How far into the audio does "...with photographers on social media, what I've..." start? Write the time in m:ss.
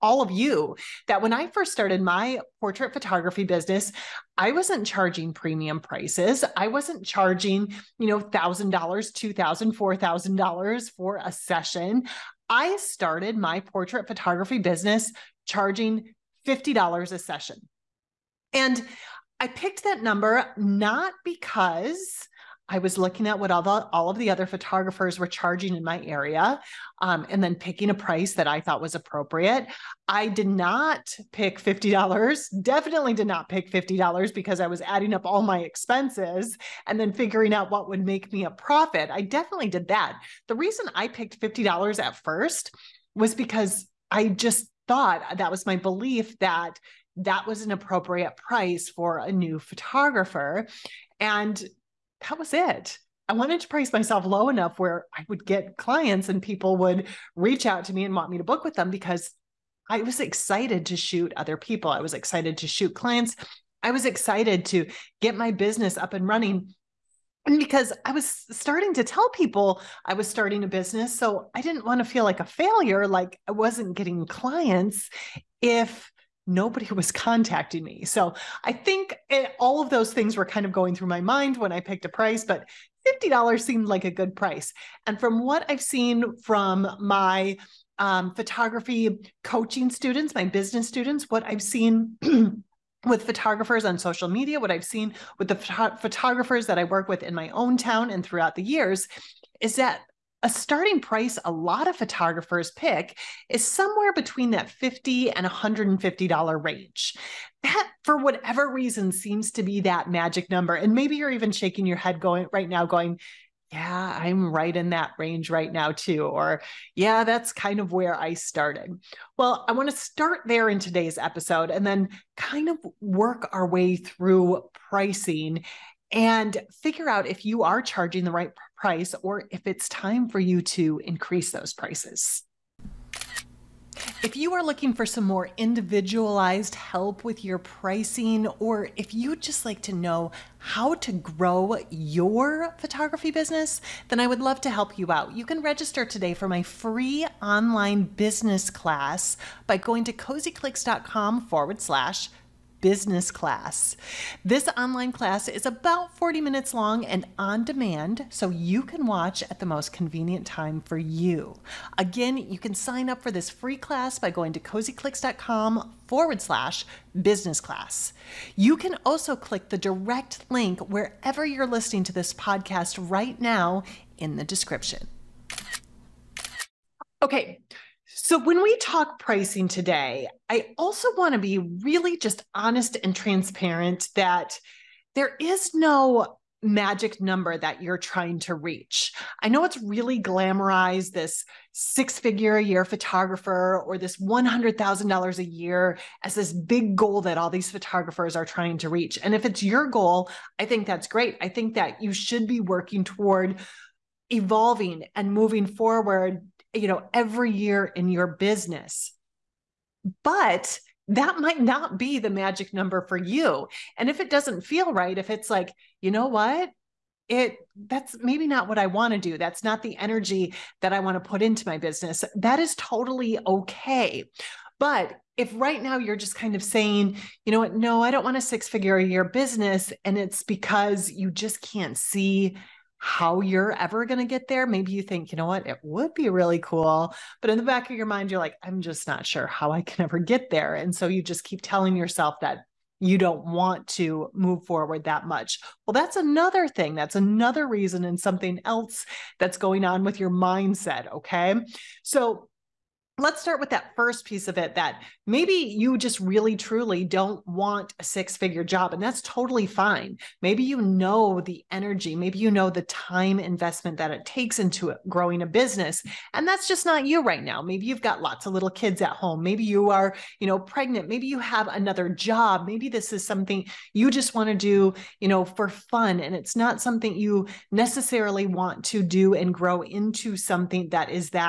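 1:33.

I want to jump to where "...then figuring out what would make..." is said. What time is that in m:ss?
0:37.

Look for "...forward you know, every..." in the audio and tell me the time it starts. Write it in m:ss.
3:25.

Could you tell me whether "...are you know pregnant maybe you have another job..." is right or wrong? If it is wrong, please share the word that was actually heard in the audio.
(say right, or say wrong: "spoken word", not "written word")
right.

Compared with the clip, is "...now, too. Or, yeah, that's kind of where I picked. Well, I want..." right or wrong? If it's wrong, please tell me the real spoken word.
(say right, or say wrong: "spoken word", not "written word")
wrong: "started", not "picked".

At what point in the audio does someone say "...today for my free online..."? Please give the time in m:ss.
2:26.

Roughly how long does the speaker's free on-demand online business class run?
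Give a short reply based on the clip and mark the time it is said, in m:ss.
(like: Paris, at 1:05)
40 minutes, at 2:36.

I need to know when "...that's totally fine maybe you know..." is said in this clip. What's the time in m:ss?
4:19.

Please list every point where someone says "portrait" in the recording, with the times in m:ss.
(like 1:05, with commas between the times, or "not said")
0:02, 0:13.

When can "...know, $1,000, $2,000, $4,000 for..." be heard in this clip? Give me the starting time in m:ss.
0:08.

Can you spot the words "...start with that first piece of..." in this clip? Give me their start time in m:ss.
4:13.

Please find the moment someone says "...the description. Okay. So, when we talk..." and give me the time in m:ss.
2:54.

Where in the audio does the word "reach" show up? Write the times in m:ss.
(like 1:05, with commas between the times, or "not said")
0:57, 3:08, 3:18.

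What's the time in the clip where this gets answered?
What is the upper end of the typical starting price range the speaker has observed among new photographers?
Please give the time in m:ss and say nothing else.
1:45.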